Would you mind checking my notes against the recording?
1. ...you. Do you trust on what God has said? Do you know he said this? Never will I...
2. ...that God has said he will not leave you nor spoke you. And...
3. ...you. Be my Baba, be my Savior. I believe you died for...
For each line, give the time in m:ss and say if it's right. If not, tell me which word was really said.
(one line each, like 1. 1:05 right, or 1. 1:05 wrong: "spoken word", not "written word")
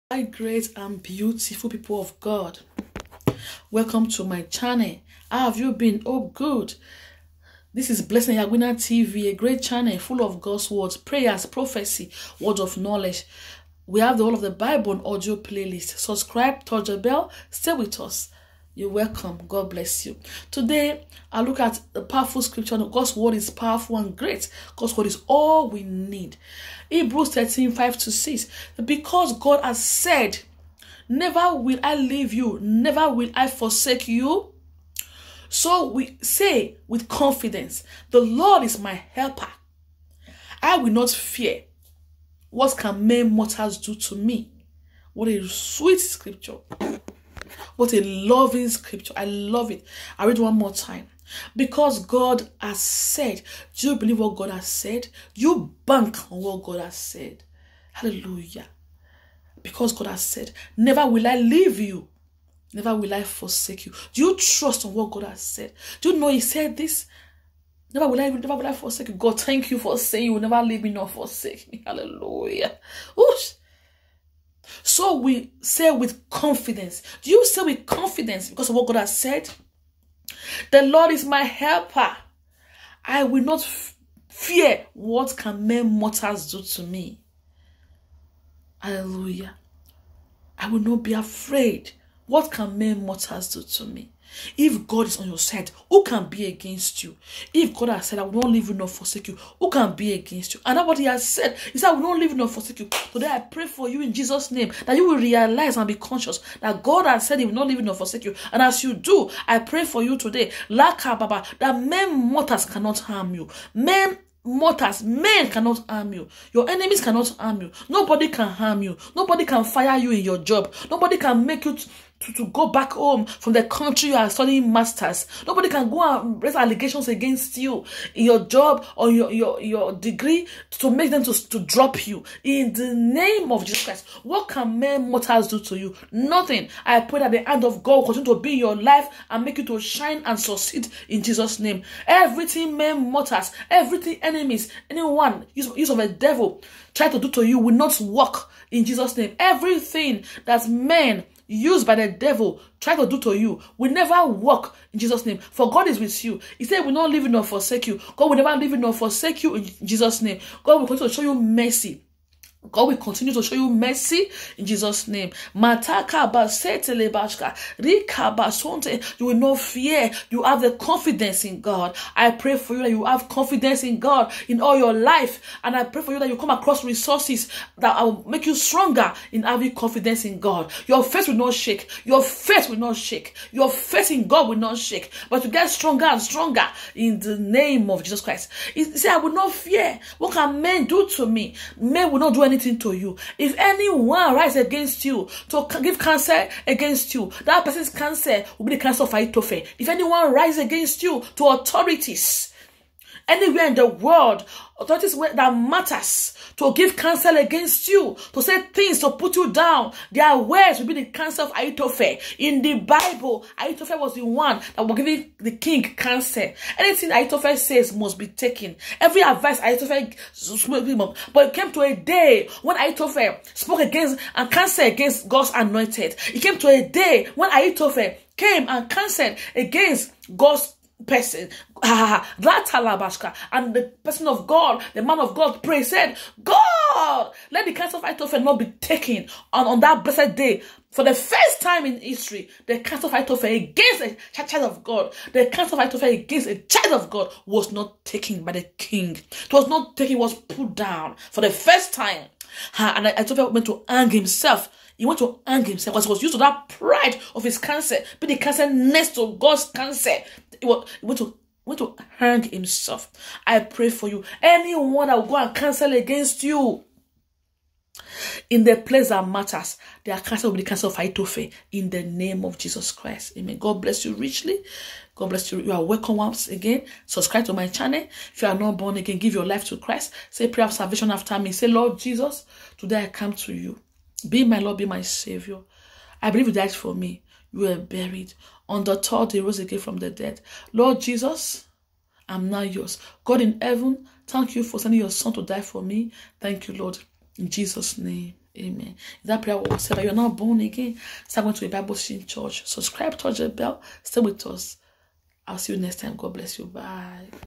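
1. 1:03 right
2. 1:46 wrong: "forsake", not "spoke"
3. 4:43 wrong: "Lord", not "Baba".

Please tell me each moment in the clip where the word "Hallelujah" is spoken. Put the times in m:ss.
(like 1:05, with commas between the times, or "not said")
0:57, 1:11, 1:28.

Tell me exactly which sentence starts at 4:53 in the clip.
God in heaven, thank you for sending your son to die for me.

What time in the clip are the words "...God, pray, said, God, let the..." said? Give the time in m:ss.
3:55.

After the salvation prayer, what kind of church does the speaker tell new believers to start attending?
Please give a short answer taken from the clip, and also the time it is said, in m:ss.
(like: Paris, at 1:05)
A Bible Christian church, at 5:01.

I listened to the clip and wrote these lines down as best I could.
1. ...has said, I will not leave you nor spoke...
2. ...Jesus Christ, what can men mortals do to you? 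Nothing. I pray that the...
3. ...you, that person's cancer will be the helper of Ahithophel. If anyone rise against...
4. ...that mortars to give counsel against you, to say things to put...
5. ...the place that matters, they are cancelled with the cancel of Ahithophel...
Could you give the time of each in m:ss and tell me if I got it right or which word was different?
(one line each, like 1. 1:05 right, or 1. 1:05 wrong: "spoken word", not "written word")
1. 1:37 wrong: "forsake", not "spoke"
2. 2:13 right
3. 3:17 wrong: "cancer", not "helper"
4. 3:25 wrong: "matters", not "mortars"
5. 4:28 right.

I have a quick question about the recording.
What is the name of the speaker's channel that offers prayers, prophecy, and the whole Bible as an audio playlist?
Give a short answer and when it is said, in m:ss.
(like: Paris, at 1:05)
Blessing Ehiagwina TV, at 0:08.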